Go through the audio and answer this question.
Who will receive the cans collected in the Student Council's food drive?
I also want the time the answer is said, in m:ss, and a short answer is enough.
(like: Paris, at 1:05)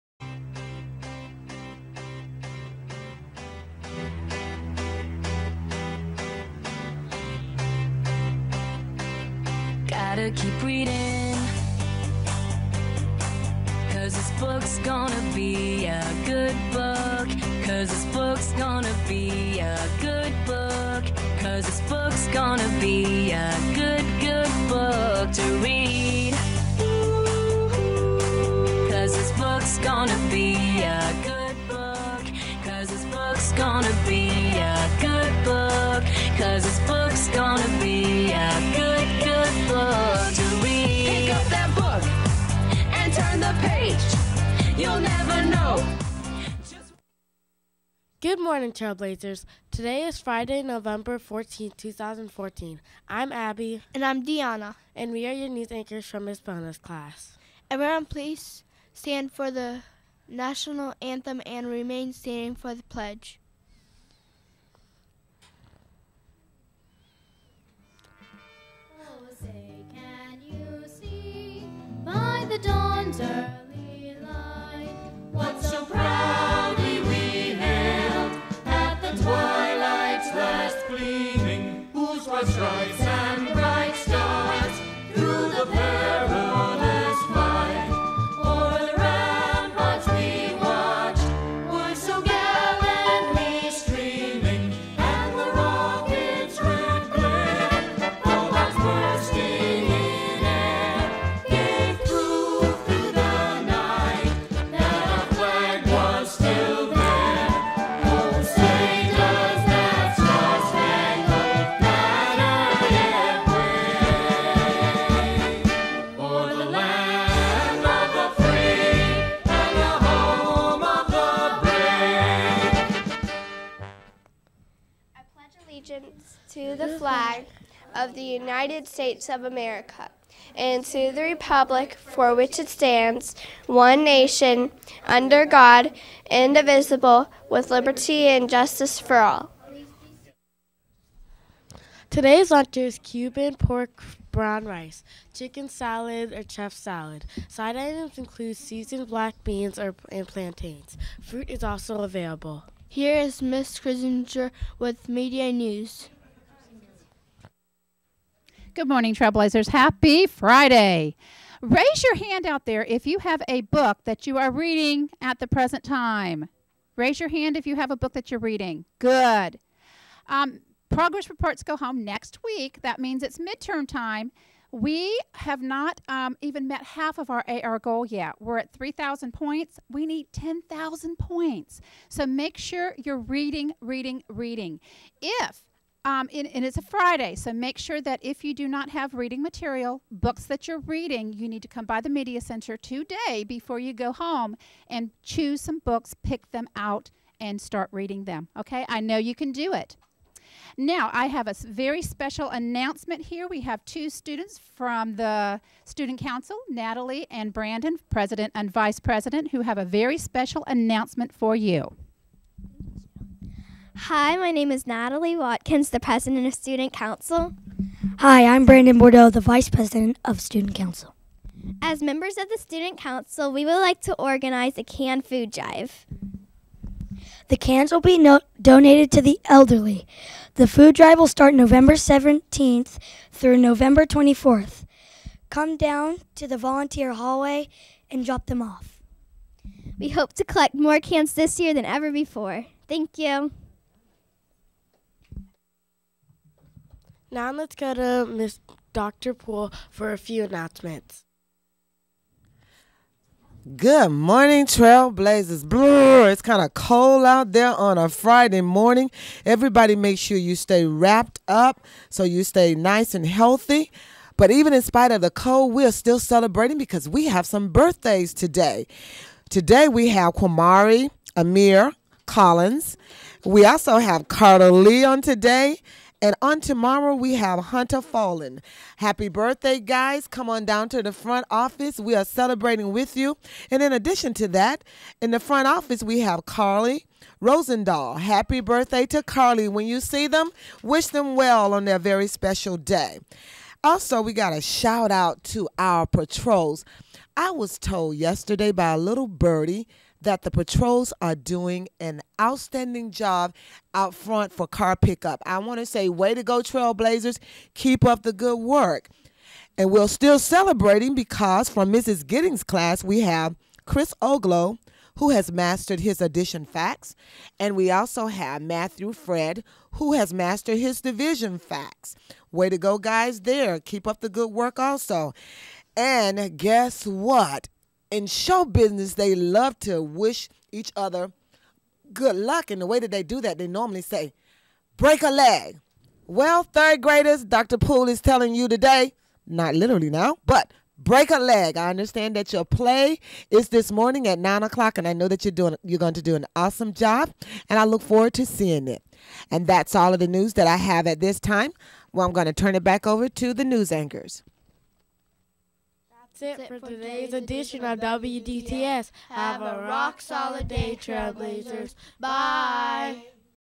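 the elderly, at 3:49.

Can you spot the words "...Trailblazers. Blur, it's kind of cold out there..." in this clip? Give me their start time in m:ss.
4:14.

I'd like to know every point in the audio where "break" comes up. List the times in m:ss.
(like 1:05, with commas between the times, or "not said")
5:34, 5:40.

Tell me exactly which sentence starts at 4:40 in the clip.
Come on down to the front office.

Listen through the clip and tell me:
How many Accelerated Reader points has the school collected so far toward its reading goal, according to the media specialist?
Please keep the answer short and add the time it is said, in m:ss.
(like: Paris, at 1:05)
3,000, at 2:58.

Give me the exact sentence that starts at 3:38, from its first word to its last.
Hi, I'm Brandon Bordeaux, the Vice President of Student Council.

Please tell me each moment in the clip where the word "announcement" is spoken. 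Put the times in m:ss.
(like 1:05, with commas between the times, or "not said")
3:22, 3:30, 4:10.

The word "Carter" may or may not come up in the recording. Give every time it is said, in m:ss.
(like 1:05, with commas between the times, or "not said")
4:34.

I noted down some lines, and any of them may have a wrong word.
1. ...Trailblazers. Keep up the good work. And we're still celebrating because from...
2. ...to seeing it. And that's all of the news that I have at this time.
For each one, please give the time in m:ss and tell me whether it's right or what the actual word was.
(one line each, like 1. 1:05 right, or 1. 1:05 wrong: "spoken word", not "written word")
1. 5:06 right
2. 5:48 right.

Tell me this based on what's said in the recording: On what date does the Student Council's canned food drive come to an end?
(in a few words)
November 24.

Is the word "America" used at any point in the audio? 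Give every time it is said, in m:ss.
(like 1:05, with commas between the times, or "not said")
2:09.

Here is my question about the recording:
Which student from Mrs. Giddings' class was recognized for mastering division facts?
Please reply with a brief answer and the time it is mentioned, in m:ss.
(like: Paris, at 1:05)
Matthew Fred, at 5:18.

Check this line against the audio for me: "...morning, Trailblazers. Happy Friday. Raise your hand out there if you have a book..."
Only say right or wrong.
right.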